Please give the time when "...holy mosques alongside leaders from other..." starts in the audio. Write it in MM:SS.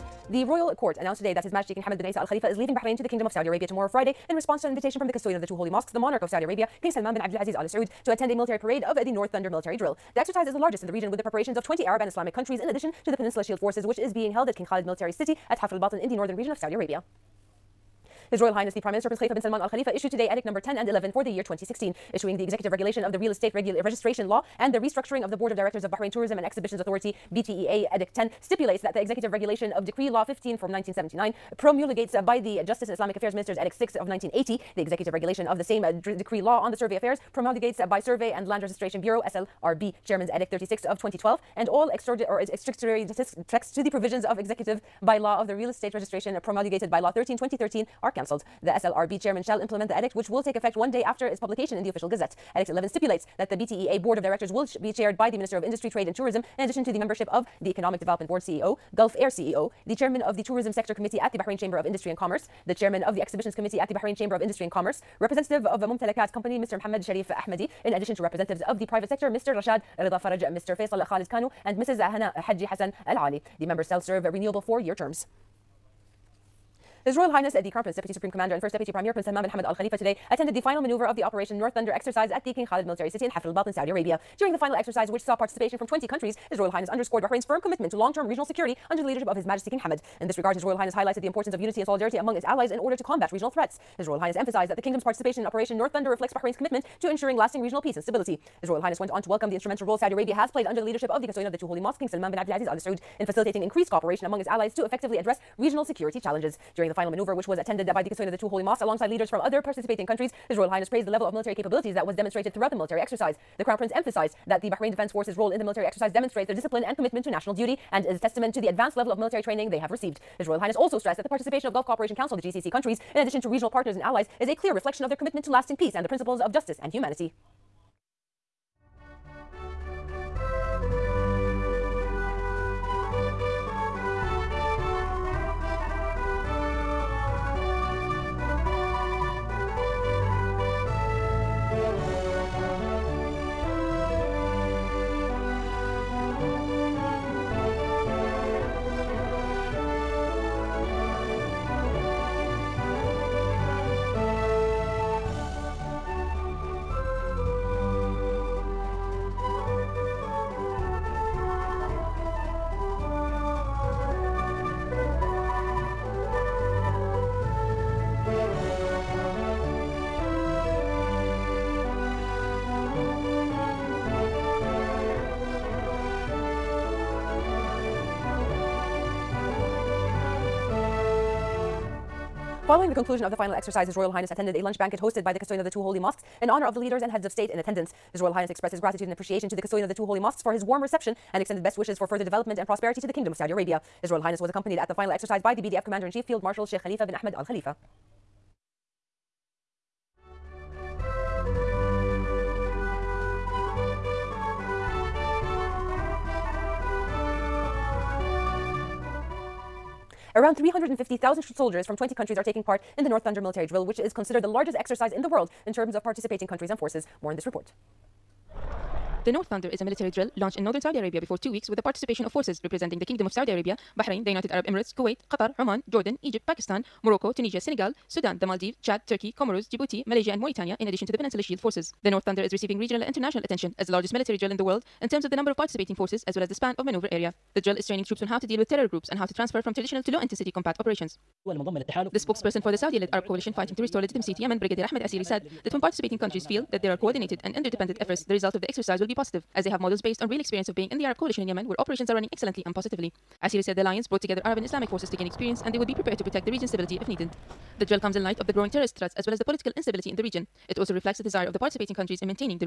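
01:48.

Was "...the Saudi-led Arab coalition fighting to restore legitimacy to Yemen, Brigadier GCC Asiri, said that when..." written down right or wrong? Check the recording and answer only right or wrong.
wrong.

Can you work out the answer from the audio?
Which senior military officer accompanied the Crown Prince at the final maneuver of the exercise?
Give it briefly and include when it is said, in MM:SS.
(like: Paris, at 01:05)
Sheikh Khalifa bin Ahmed Al Khalifa, at 03:16.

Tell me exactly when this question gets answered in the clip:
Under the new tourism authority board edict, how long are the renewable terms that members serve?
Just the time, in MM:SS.
01:14.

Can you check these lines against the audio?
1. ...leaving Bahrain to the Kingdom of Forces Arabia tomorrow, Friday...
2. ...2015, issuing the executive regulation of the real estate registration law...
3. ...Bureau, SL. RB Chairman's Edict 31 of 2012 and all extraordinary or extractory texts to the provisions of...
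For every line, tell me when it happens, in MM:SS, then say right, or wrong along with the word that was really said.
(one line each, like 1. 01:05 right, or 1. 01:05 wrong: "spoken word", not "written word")
1. 00:02 wrong: "Saudi", not "Forces"
2. 00:21 wrong: "2016", not "2015"
3. 00:39 wrong: "36", not "31".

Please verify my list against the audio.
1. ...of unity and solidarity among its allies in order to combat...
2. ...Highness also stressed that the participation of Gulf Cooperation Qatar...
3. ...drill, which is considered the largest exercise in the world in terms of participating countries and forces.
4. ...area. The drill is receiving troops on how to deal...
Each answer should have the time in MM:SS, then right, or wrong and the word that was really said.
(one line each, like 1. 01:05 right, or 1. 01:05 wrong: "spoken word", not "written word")
1. 01:31 right
2. 02:00 wrong: "Council", not "Qatar"
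3. 03:33 right
4. 03:57 wrong: "training", not "receiving".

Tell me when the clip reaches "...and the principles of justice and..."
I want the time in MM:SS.
02:05.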